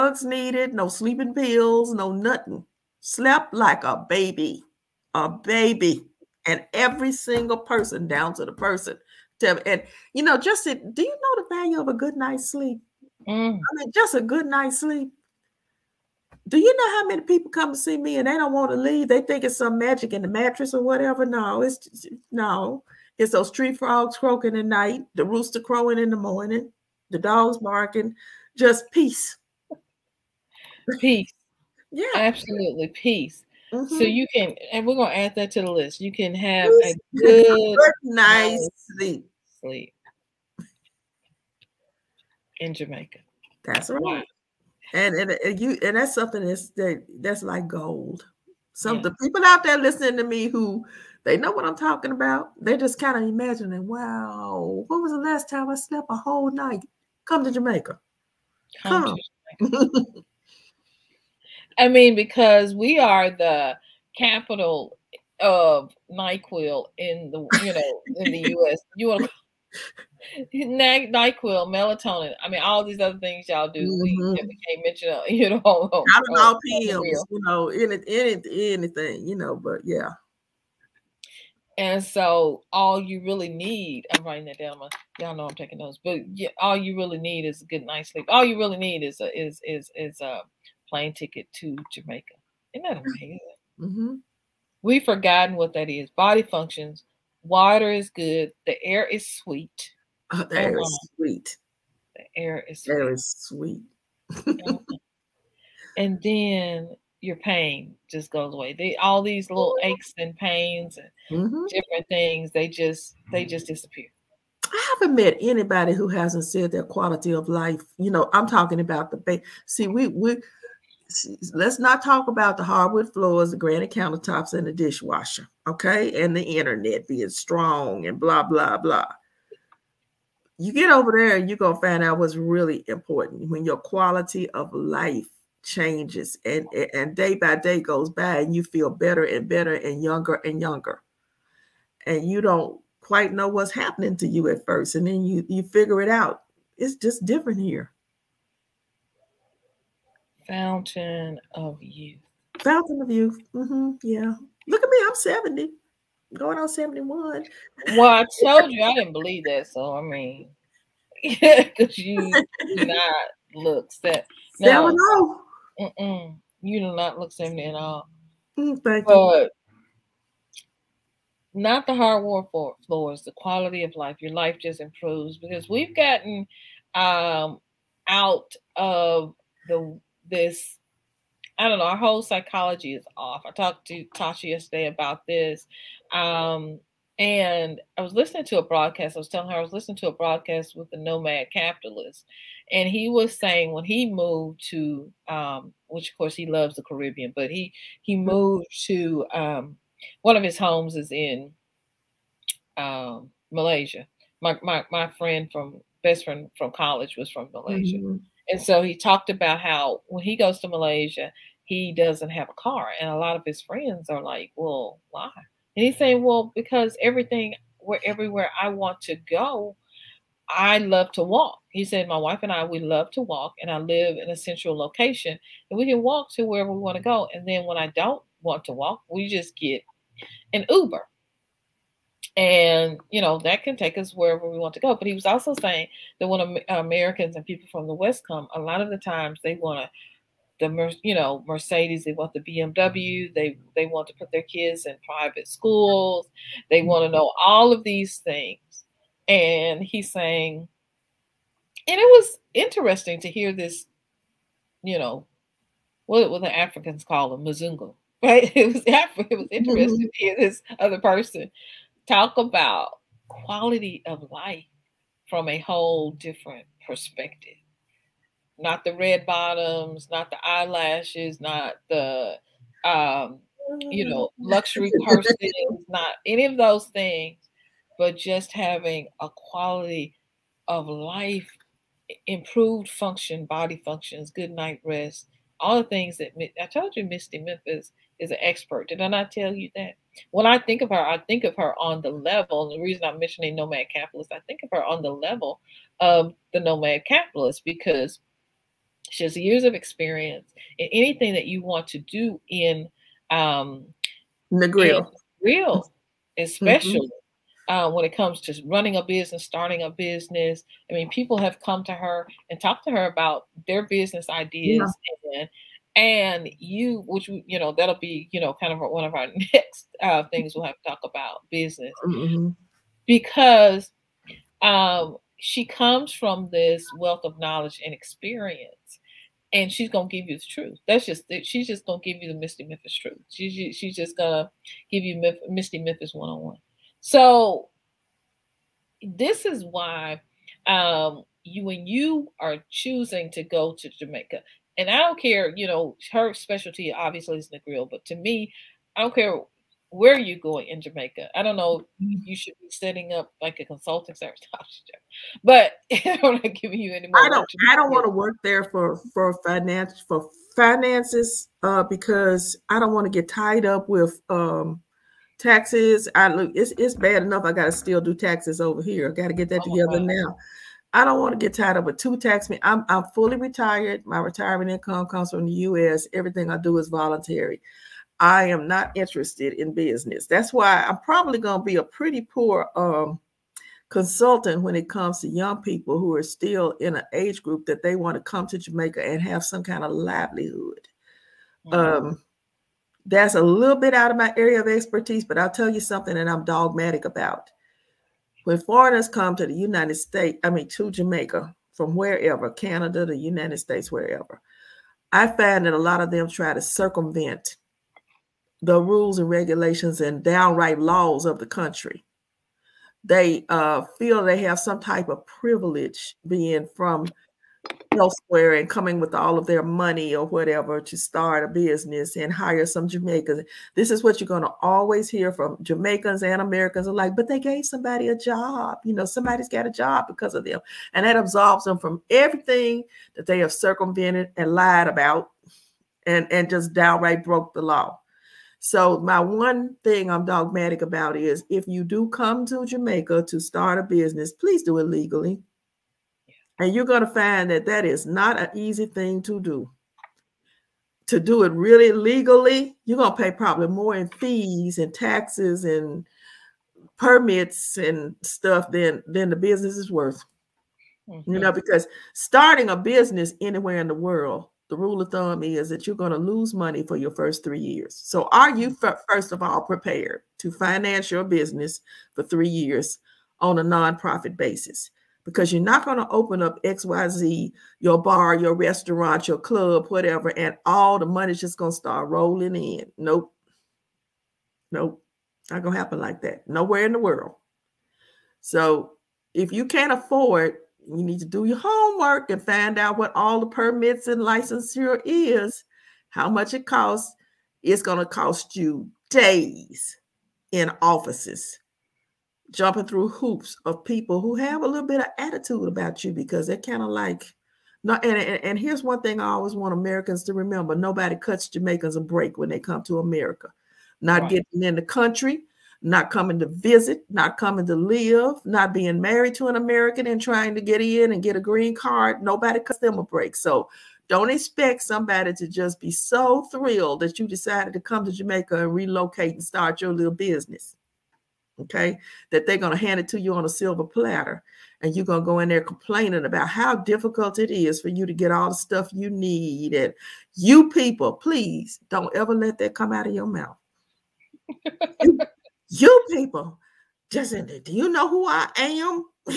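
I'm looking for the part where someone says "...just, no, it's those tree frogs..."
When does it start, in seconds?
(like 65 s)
21 s.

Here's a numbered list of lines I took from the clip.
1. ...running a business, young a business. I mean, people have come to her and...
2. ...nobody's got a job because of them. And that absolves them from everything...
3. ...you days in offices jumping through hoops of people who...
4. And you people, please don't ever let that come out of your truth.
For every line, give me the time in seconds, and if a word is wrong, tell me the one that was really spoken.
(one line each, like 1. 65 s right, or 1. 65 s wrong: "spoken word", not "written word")
1. 308 s wrong: "starting", not "young"
2. 429 s wrong: "somebody", not "nobody"
3. 498 s right
4. 539 s wrong: "mouth", not "truth".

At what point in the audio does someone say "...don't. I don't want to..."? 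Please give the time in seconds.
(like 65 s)
357 s.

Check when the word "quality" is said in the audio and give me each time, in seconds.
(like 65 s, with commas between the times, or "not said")
116 s, 133 s, 173 s, 263 s, 279 s.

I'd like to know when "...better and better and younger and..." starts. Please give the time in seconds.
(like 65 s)
138 s.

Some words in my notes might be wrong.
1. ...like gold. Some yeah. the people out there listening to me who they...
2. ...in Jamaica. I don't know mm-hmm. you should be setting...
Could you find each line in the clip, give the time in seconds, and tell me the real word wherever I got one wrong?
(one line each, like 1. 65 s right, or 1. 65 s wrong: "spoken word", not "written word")
1. 47 s right
2. 350 s right.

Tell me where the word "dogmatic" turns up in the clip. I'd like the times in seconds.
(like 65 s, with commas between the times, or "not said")
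396 s, 440 s.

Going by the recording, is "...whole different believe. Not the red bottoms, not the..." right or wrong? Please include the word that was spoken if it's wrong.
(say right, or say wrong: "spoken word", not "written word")
wrong: "perspective", not "believe".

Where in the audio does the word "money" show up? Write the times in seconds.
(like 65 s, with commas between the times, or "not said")
419 s, 466 s, 481 s.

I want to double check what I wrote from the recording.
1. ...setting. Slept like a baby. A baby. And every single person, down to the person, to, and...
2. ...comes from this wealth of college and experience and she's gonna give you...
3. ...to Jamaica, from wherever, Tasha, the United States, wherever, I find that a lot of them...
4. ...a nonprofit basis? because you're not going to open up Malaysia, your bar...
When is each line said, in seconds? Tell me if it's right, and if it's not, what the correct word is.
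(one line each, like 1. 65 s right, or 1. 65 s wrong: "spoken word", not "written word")
1. 2 s wrong: "nothing", not "setting"
2. 325 s wrong: "knowledge", not "college"
3. 400 s wrong: "Canada", not "Tasha"
4. 473 s wrong: "XYZ", not "Malaysia".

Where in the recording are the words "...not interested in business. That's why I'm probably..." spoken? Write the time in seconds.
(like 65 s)
378 s.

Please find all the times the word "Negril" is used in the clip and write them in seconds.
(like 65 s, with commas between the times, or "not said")
304 s, 347 s.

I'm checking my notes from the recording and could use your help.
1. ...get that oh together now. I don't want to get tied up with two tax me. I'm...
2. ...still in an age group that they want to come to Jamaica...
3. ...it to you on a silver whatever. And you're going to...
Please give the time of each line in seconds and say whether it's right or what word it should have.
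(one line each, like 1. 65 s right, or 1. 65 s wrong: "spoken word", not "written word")
1. 369 s right
2. 386 s right
3. 532 s wrong: "platter", not "whatever".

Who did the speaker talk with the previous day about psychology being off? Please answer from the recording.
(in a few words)
Tasha.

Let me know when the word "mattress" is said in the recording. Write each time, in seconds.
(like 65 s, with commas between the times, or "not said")
20 s.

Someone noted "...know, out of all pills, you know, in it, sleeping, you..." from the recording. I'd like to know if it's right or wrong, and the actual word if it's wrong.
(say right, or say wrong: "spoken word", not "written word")
wrong: "anything", not "sleeping".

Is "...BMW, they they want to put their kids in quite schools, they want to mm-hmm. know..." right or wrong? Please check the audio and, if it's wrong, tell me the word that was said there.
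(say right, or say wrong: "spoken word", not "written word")
wrong: "private", not "quite".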